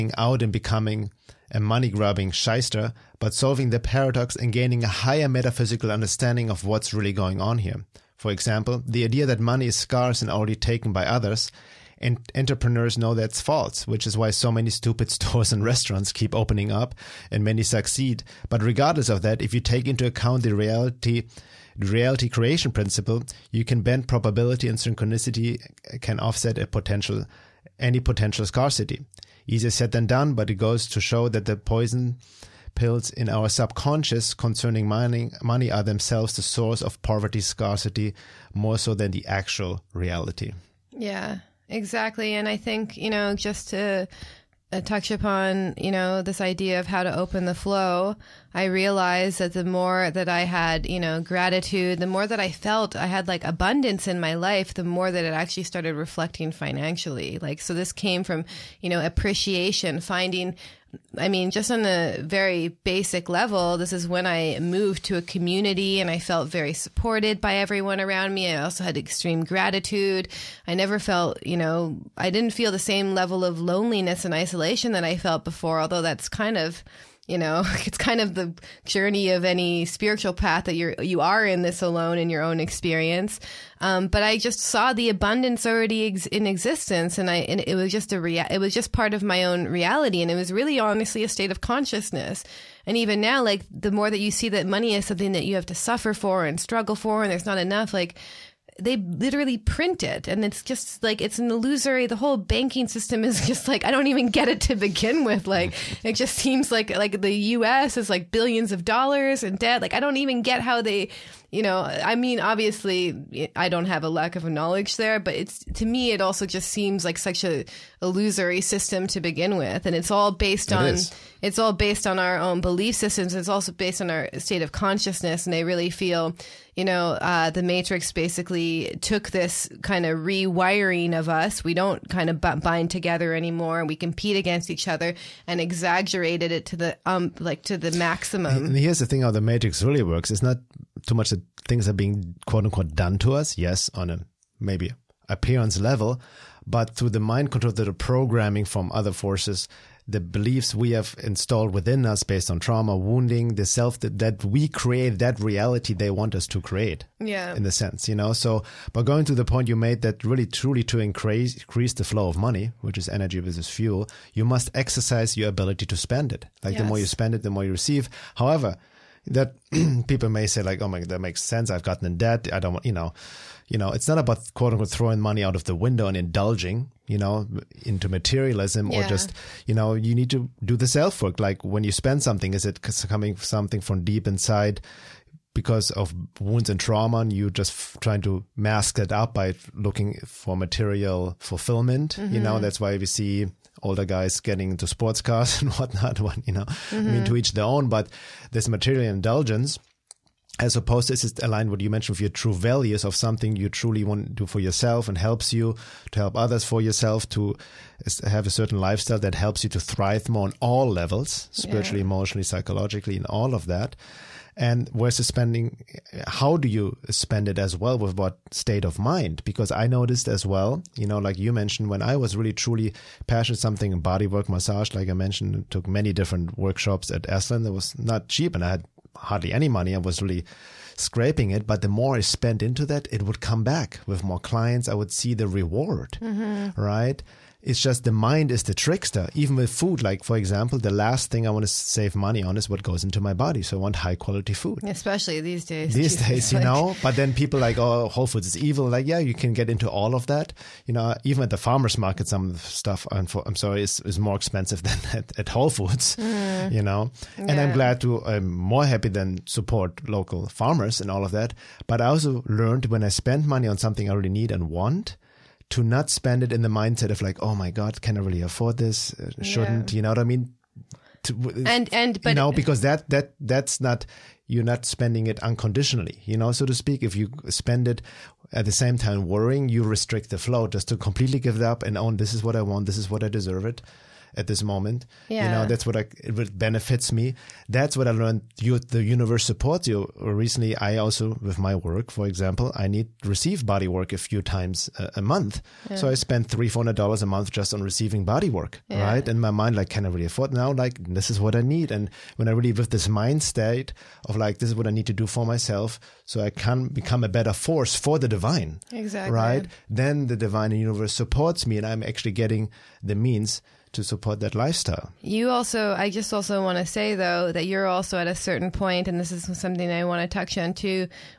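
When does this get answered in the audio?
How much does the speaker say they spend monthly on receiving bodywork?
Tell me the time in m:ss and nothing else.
4:56.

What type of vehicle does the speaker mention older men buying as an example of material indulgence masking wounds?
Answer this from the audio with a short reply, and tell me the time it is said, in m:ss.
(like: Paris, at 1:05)
Sports cars, at 3:14.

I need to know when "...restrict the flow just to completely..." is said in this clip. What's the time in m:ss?
4:39.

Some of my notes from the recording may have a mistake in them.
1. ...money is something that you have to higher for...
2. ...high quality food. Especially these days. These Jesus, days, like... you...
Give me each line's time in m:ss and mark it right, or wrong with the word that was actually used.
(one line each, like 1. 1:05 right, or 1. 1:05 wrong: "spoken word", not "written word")
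1. 1:34 wrong: "suffer", not "higher"
2. 4:03 right.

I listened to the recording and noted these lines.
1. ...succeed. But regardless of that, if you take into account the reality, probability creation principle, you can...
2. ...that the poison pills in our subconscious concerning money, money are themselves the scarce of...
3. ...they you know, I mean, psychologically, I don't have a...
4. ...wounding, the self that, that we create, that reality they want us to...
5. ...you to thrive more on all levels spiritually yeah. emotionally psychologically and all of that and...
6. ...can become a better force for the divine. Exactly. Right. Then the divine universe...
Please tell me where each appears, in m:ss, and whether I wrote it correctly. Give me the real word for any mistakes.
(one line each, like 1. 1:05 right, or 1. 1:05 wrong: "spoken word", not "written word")
1. 0:17 wrong: "reality", not "probability"
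2. 0:31 wrong: "source", not "scarce"
3. 1:50 wrong: "obviously", not "psychologically"
4. 2:32 right
5. 3:29 right
6. 5:06 right.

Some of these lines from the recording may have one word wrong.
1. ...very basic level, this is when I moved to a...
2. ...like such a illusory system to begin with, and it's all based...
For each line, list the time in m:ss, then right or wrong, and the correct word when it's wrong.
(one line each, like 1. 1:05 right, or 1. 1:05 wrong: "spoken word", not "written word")
1. 1:02 right
2. 1:57 right.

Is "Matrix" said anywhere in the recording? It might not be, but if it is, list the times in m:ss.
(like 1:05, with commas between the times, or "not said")
2:07, 2:19.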